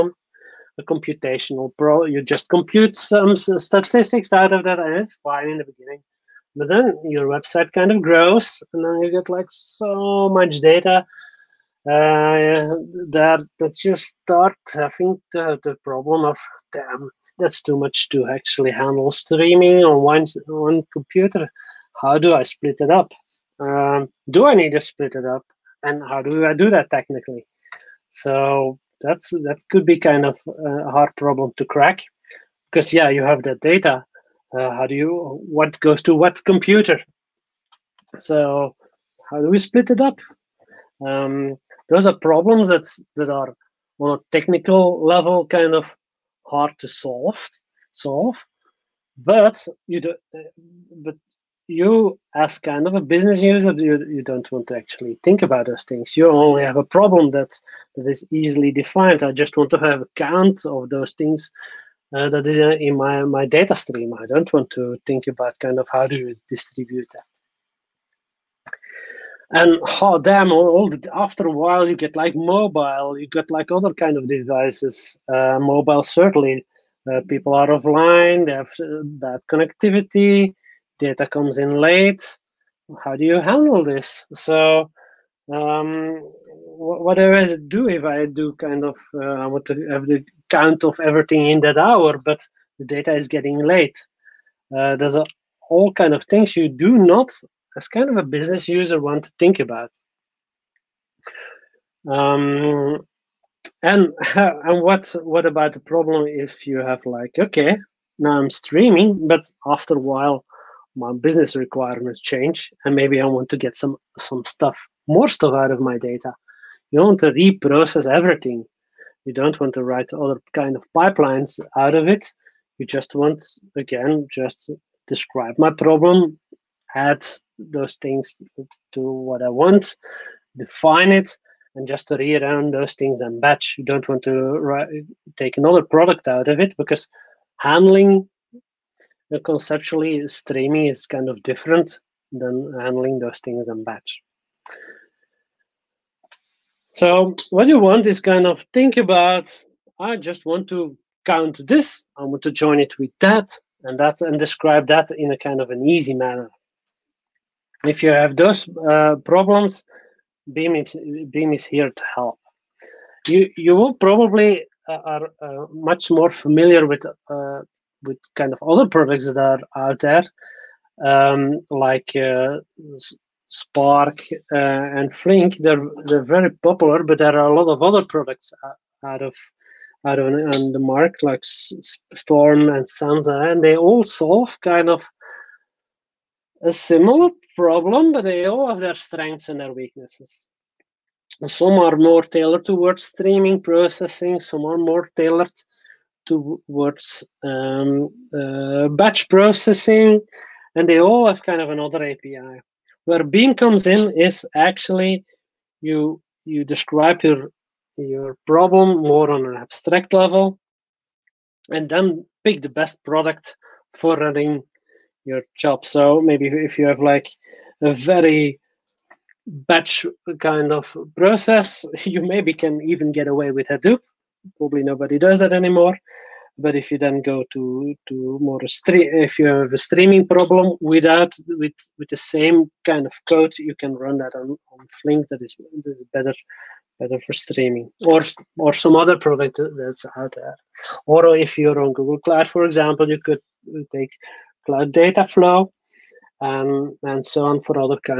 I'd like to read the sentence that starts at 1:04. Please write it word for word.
I don't want to think about kind of how do you distribute that.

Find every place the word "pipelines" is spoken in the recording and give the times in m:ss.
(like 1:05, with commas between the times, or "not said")
2:00.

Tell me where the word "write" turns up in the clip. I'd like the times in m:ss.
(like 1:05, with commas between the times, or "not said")
1:59, 2:14.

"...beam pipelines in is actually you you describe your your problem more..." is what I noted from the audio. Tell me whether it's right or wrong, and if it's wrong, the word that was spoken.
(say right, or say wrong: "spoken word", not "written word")
wrong: "comes", not "pipelines".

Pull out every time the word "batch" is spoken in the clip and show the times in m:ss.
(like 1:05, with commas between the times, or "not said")
2:13, 2:23, 3:18, 3:39.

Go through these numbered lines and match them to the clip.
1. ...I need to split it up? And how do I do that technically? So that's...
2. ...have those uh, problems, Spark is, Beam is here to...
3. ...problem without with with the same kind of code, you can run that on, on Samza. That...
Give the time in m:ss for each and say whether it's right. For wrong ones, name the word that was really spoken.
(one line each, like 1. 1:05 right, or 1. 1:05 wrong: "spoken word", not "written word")
1. 0:24 right
2. 2:38 wrong: "Beam", not "Spark"
3. 3:50 wrong: "Flink", not "Samza".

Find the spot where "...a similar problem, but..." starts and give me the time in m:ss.
3:06.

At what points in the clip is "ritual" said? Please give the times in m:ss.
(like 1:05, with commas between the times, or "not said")
not said.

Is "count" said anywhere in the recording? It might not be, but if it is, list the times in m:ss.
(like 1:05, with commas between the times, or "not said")
1:00, 1:30, 2:31.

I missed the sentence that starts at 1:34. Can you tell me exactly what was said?
Uh, there's a, all kind of things you do not, as kind of a business user, want to think about.